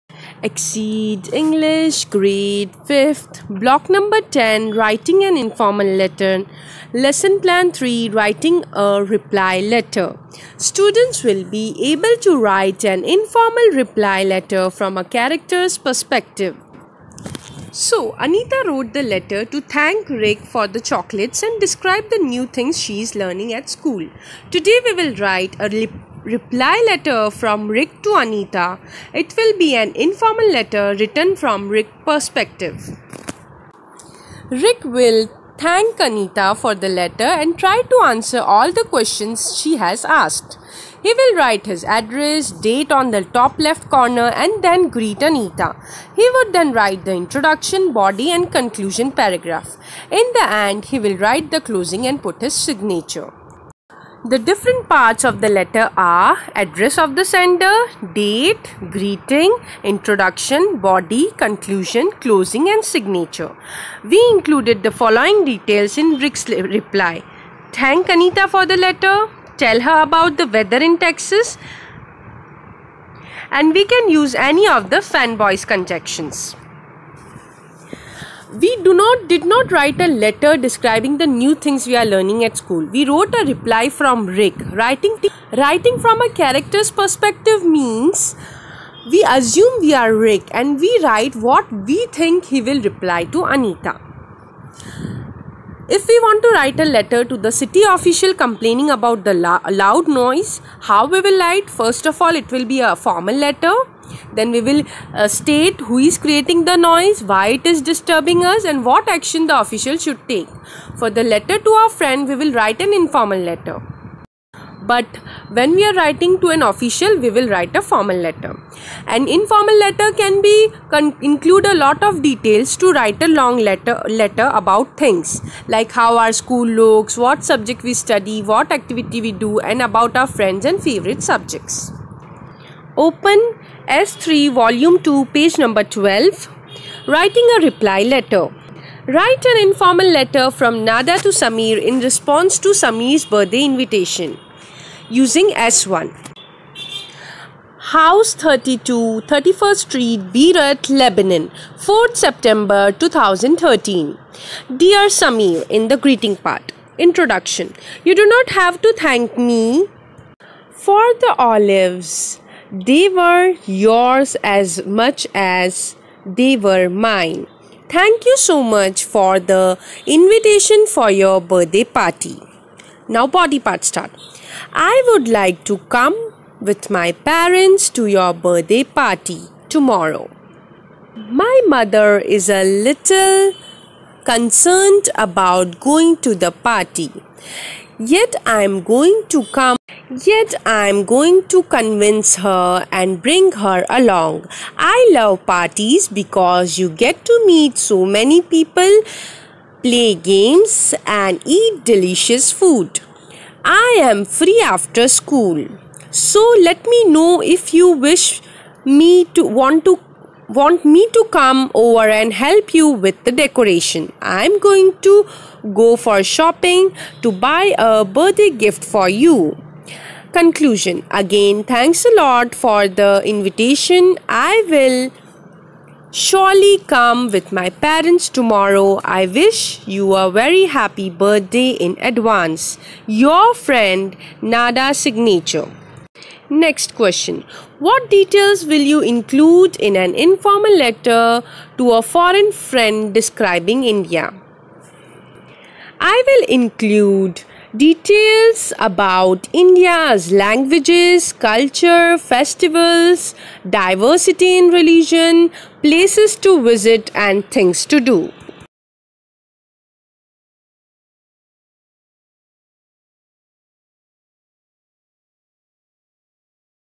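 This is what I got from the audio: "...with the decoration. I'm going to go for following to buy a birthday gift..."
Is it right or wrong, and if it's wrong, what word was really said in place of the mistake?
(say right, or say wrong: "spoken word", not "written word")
wrong: "shopping", not "following".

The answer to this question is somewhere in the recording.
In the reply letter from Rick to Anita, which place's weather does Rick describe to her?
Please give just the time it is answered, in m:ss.
1:10.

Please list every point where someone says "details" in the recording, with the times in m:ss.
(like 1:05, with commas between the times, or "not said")
1:05, 2:02, 3:58, 4:07.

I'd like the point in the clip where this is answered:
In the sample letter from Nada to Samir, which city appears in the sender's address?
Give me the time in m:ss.
2:30.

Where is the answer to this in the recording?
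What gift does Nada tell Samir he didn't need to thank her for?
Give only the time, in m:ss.
2:41.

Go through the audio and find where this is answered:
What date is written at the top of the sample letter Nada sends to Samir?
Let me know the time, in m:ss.
2:31.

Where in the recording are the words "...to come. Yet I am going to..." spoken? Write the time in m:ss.
3:09.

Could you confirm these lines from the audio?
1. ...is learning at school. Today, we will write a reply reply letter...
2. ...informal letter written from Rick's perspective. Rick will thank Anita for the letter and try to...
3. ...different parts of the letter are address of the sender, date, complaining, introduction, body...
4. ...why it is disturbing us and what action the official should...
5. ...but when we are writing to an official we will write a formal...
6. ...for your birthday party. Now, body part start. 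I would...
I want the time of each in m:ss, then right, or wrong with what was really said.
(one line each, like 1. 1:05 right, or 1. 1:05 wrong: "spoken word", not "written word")
1. 0:23 right
2. 0:29 right
3. 0:54 wrong: "greeting", not "complaining"
4. 1:47 right
5. 1:54 right
6. 2:50 right.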